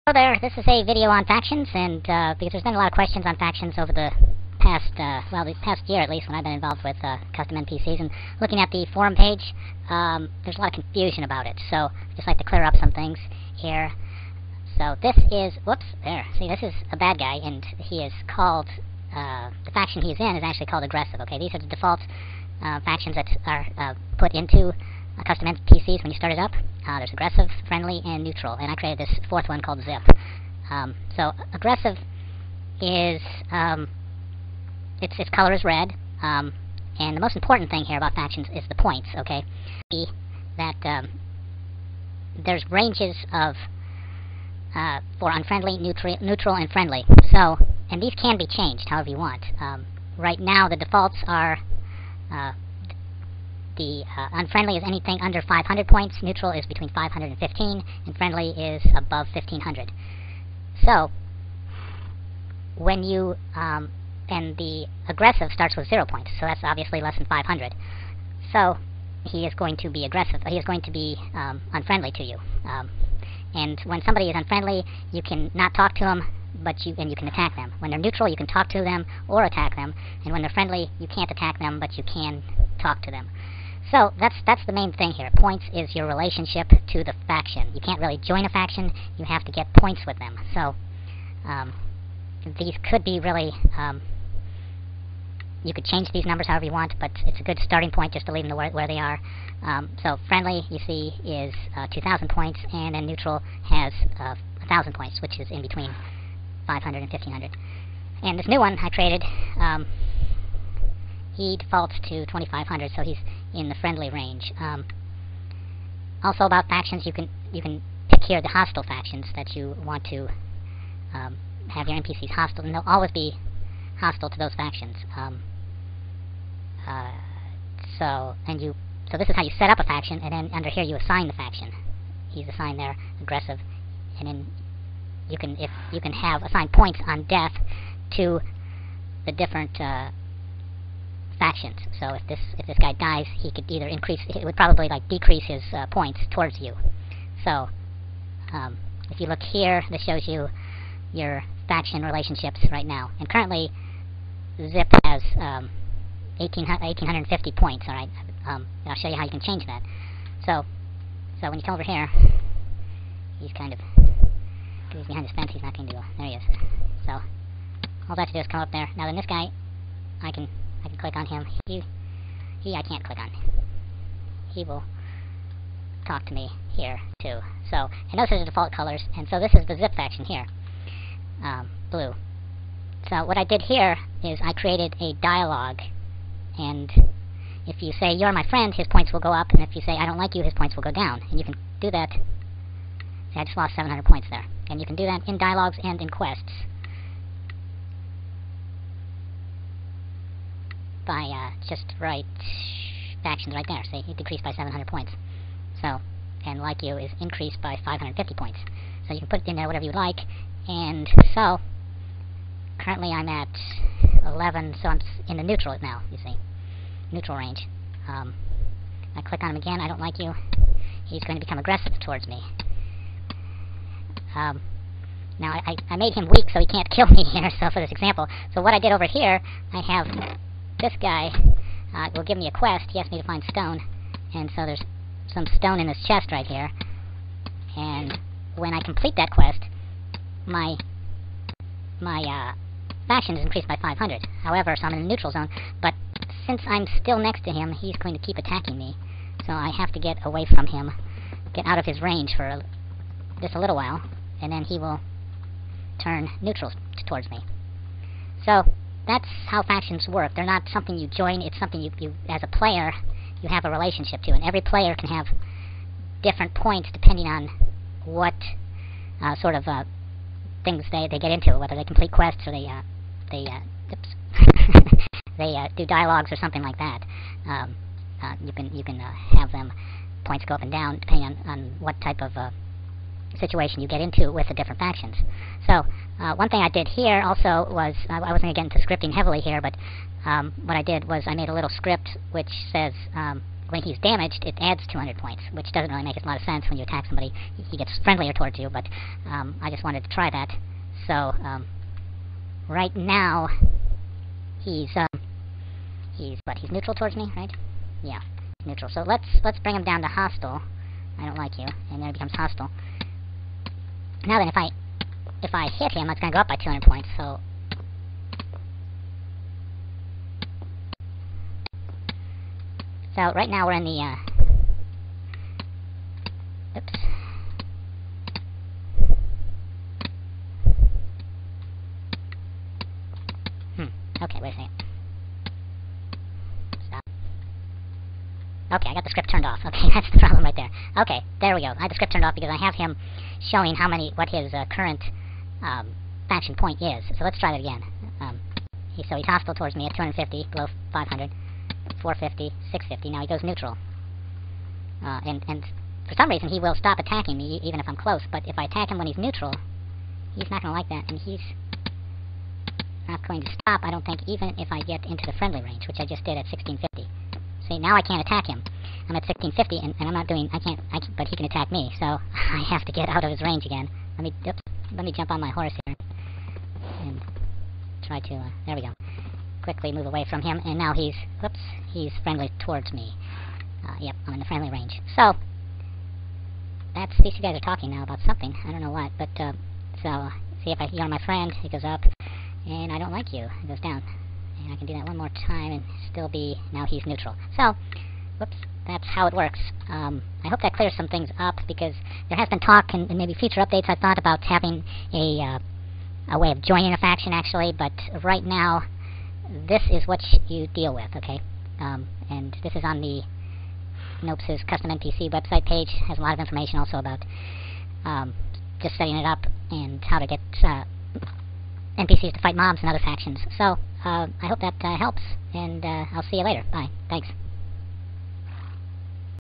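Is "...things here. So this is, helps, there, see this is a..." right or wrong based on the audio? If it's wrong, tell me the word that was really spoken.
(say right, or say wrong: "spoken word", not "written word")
wrong: "whoops", not "helps".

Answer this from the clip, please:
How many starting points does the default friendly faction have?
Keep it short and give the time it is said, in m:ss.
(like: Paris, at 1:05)
2,000, at 1:41.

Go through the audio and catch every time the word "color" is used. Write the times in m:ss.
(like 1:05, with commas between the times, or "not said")
0:35, 2:58.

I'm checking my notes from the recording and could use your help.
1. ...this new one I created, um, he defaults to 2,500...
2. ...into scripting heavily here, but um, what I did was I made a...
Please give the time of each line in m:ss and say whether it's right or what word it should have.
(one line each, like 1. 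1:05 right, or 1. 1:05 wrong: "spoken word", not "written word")
1. 1:48 right
2. 4:48 right.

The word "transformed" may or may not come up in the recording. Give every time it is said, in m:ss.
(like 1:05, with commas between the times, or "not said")
not said.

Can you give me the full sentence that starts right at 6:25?
So, that's, these two guys are talking now about something.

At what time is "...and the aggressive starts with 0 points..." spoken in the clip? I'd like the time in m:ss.
1:04.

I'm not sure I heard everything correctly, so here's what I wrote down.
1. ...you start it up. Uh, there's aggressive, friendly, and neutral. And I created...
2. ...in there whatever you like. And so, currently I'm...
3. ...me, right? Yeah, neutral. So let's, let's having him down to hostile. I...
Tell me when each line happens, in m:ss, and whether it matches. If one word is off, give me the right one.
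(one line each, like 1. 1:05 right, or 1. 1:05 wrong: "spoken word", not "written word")
1. 0:26 right
2. 3:29 right
3. 5:07 wrong: "bring", not "having".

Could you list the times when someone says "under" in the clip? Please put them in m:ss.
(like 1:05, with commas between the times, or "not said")
0:55, 2:10.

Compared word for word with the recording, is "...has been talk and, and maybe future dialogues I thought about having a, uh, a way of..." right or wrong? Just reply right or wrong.
wrong.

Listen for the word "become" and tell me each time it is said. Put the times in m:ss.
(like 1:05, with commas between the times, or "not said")
3:41, 5:12.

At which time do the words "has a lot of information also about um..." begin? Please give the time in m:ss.
6:56.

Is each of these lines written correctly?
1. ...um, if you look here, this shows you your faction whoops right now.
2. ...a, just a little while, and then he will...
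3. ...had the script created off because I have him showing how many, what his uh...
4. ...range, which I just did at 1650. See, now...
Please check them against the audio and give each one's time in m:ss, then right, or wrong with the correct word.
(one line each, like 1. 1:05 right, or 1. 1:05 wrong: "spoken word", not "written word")
1. 2:28 wrong: "relationships", not "whoops"
2. 4:12 right
3. 5:41 wrong: "turned", not "created"
4. 6:05 right.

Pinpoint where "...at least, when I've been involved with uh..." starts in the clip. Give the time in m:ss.
0:06.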